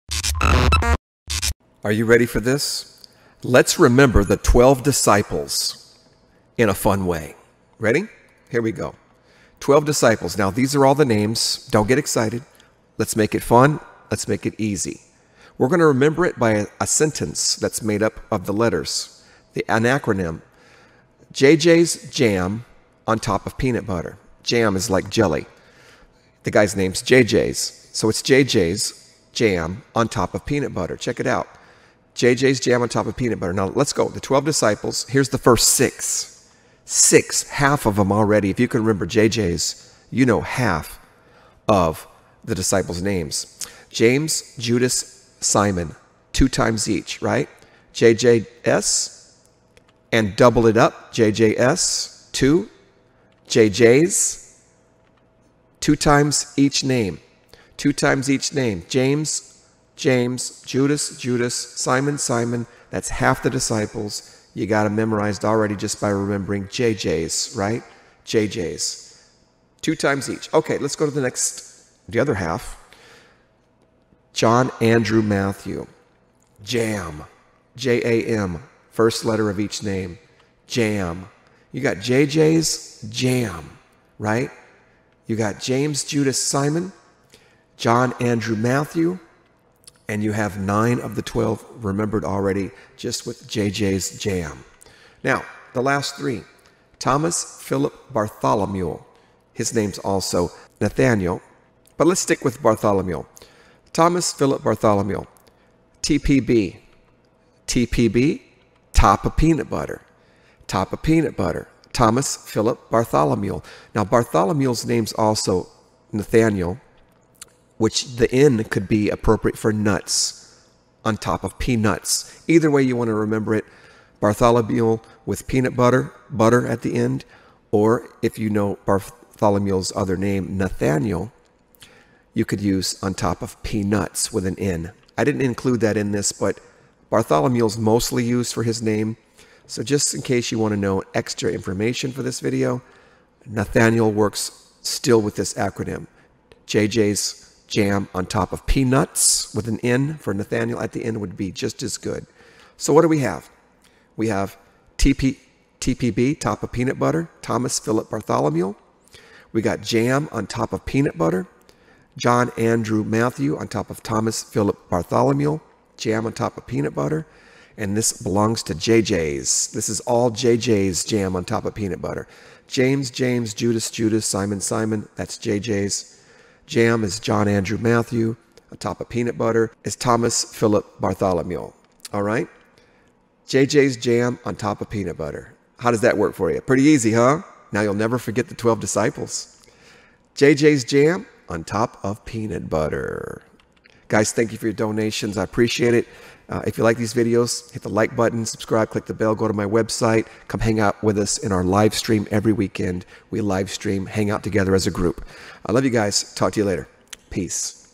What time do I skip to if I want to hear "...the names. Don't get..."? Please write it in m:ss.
0:10.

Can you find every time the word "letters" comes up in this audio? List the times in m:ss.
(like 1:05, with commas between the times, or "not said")
0:18, 1:19.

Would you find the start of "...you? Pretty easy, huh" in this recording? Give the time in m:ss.
3:06.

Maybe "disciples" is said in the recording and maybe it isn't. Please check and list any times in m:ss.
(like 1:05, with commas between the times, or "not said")
0:04, 0:09, 0:34, 0:42, 1:03, 3:08.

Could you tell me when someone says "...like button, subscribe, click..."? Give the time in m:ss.
3:17.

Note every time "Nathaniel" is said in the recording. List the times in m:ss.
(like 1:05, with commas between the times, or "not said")
1:40, 1:56, 2:10, 2:23, 2:30.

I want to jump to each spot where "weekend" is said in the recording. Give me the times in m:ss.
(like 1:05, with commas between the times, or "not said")
3:22.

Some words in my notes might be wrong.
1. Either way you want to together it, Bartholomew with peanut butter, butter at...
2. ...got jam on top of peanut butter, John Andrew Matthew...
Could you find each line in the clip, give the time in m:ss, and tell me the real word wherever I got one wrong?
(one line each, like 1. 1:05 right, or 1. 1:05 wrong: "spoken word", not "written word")
1. 2:02 wrong: "remember", not "together"
2. 2:39 right.